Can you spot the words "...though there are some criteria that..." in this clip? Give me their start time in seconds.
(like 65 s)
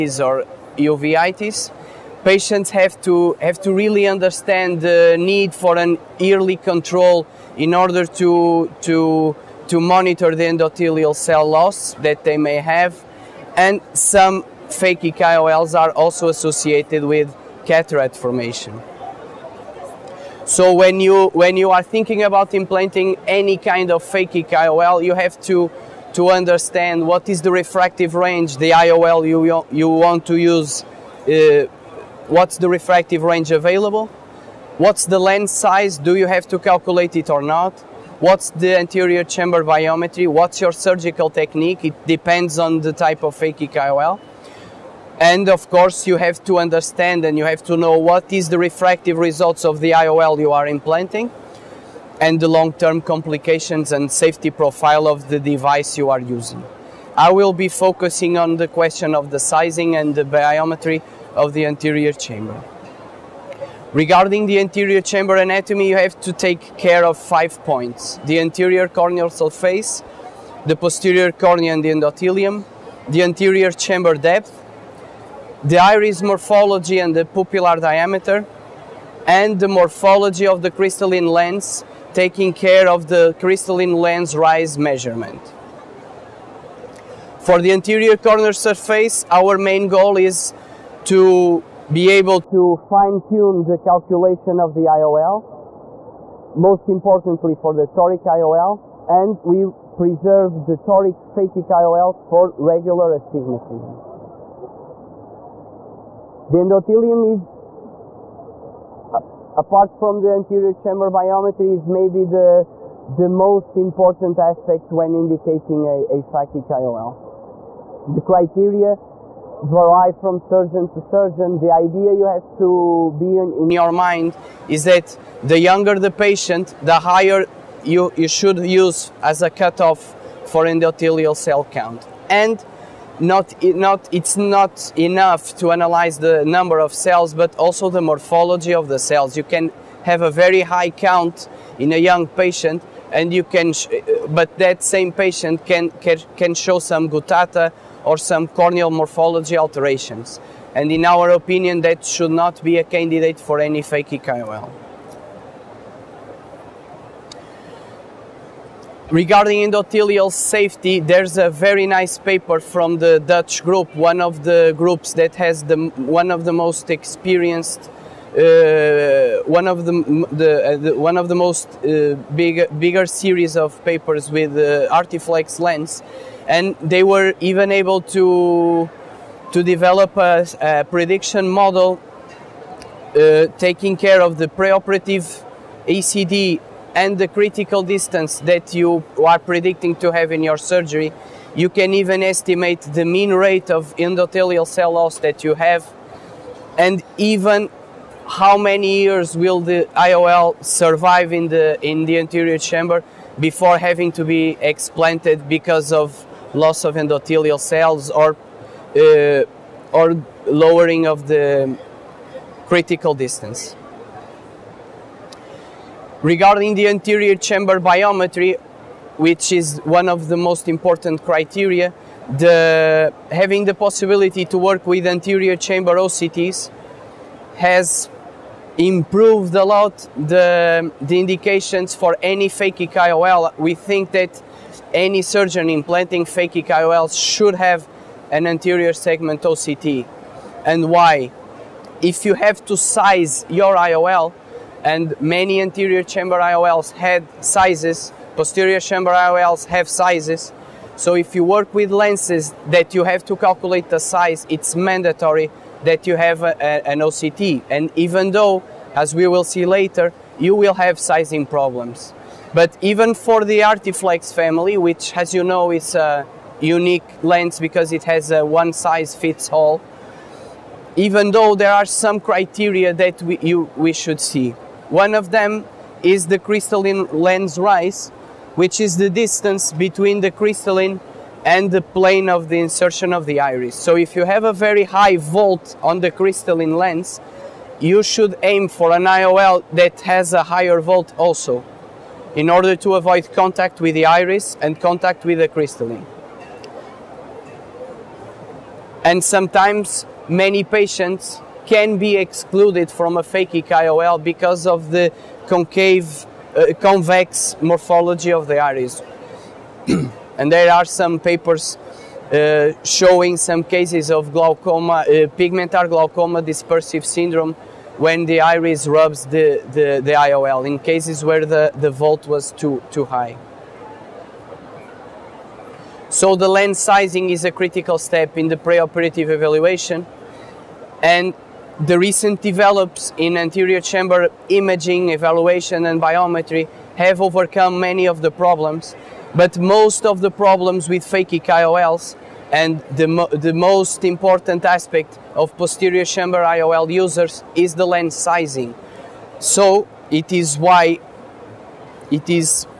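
271 s.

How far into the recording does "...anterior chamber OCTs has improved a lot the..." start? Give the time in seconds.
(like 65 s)
225 s.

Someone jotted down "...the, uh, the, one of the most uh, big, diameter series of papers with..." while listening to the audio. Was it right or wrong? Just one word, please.
wrong.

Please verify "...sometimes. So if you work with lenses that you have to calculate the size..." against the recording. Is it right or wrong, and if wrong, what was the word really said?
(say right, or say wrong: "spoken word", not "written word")
wrong: "sizes", not "sometimes".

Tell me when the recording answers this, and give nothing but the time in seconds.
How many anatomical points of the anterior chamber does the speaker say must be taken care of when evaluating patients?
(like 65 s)
67 s.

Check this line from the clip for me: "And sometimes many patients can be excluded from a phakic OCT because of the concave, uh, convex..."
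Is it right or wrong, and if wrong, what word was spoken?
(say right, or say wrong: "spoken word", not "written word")
wrong: "IOL", not "OCT".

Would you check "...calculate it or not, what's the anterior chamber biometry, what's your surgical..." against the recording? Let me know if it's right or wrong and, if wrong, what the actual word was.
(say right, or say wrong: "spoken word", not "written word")
right.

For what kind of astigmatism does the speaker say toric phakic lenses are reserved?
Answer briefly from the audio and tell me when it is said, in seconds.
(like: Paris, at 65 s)
Regular astigmatism, at 102 s.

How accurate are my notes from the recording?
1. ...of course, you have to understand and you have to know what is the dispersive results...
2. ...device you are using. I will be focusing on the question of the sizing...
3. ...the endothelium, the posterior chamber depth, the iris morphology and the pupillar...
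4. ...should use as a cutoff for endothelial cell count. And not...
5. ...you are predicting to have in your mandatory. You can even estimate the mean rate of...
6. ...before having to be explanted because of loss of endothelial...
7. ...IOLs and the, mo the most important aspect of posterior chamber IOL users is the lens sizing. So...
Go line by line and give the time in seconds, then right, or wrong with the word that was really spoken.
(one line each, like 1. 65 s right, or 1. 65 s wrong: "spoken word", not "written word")
1. 45 s wrong: "refractive", not "dispersive"
2. 55 s right
3. 71 s wrong: "anterior", not "posterior"
4. 128 s right
5. 188 s wrong: "surgery", not "mandatory"
6. 203 s right
7. 341 s right.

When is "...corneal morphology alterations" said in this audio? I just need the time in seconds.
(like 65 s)
148 s.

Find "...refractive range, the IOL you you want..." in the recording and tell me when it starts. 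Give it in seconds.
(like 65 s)
27 s.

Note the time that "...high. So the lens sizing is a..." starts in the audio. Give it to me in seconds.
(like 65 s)
323 s.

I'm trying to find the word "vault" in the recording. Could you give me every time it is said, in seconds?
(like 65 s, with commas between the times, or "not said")
285 s, 290 s, 321 s.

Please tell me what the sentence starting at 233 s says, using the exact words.
We think that any surgeon implanting phakic IOLs should have an anterior segment OCT.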